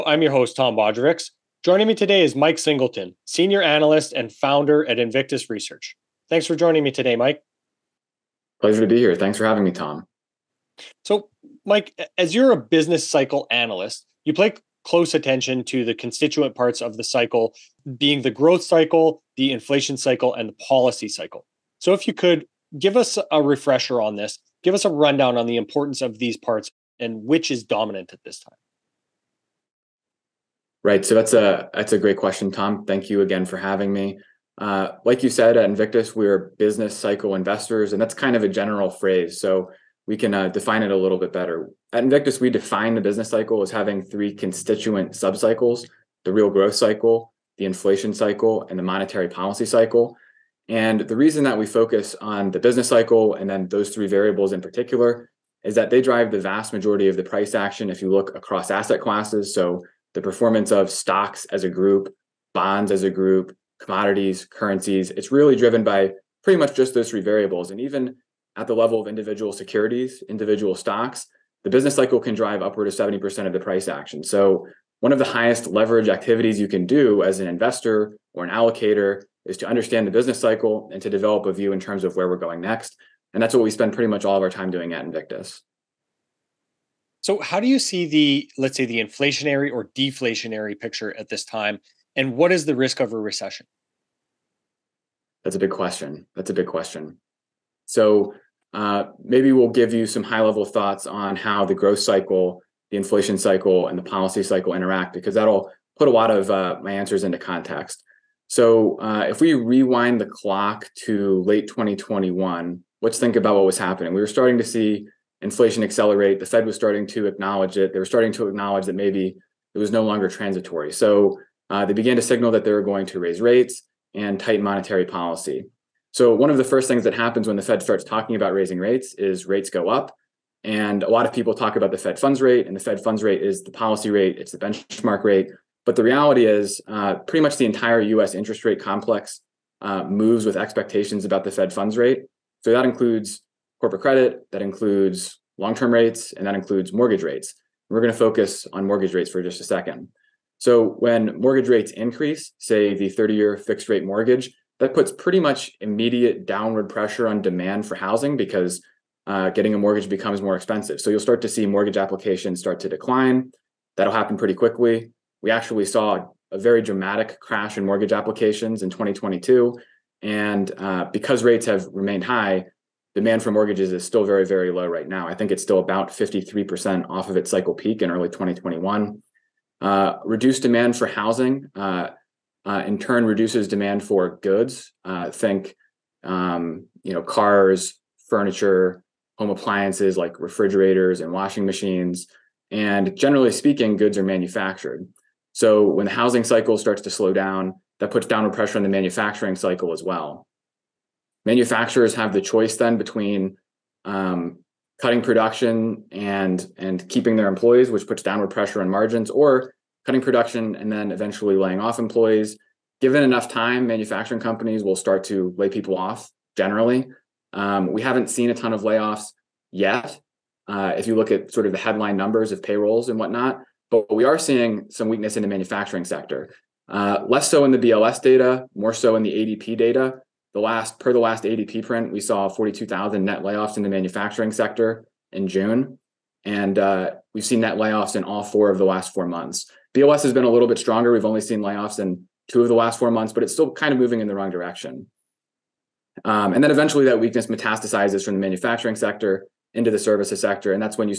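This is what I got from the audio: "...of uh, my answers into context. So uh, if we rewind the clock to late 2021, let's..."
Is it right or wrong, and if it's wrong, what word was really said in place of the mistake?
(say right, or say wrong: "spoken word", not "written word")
right.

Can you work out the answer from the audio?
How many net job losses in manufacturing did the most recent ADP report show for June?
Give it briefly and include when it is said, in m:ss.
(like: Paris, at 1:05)
42,000, at 3:52.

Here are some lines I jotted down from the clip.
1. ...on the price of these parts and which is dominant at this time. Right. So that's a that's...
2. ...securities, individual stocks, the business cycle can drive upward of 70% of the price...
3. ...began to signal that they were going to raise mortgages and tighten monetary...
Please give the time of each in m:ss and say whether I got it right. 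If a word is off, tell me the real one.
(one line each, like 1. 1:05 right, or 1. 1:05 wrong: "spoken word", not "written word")
1. 0:25 wrong: "importance", not "price"
2. 1:09 right
3. 2:01 wrong: "rates", not "mortgages".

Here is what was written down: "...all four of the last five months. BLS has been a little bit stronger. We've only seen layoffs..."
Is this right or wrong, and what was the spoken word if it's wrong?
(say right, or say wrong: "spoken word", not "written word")
wrong: "four", not "five".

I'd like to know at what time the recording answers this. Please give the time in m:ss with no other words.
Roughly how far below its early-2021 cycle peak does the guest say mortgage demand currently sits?
2:56.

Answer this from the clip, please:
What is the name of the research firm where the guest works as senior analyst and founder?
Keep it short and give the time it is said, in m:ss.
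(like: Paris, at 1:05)
Invictus Research, at 0:04.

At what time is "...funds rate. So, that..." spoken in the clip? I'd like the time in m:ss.
2:21.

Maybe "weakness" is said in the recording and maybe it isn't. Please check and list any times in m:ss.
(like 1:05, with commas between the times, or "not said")
3:45, 4:07.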